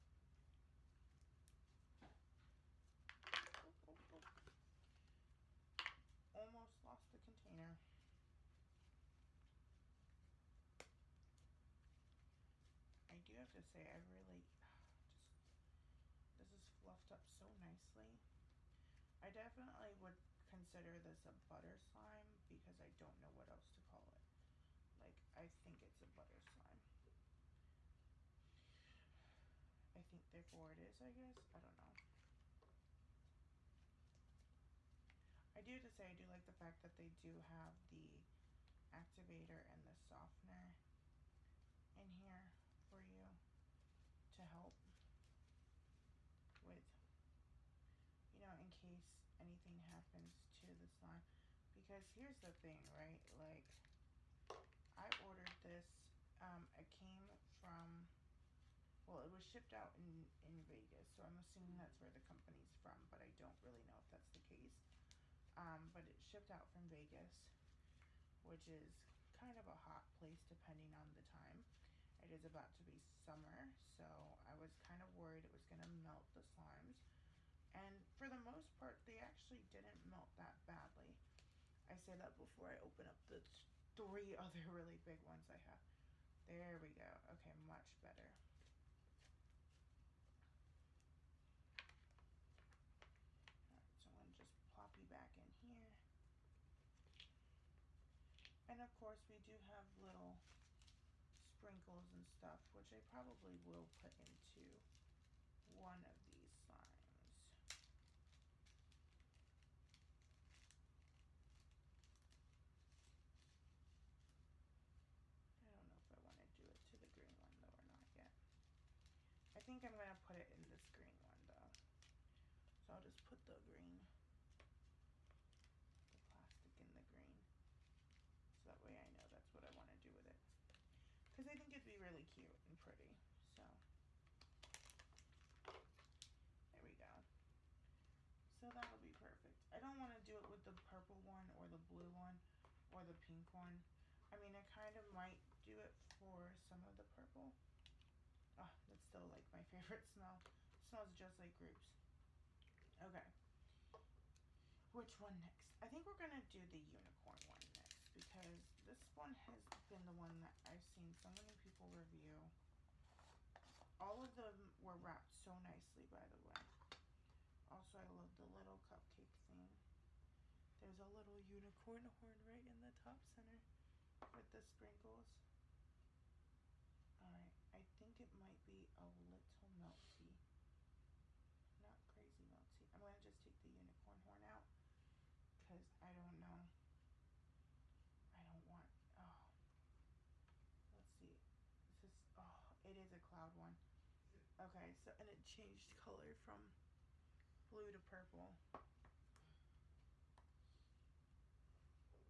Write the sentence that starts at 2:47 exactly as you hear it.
Also, I love the little cupcake thing.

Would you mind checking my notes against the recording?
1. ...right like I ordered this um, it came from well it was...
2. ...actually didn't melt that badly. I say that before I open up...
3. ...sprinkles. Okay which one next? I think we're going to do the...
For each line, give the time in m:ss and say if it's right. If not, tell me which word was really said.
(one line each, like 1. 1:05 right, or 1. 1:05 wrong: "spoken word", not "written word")
1. 0:52 right
2. 1:19 right
3. 2:31 wrong: "grapes", not "sprinkles".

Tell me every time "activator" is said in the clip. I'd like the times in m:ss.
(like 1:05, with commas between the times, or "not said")
0:38.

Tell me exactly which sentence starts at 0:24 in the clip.
Like, I think it's a butter slime.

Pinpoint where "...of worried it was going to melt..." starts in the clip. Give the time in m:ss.
1:15.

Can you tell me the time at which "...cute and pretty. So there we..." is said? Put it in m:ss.
2:12.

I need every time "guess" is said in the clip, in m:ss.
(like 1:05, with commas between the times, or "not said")
0:31.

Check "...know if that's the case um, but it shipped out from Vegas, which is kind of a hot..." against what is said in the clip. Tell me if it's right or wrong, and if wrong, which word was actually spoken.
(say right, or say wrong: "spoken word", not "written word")
right.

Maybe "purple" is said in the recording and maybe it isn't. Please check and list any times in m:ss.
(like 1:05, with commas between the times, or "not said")
2:20, 2:27, 3:17.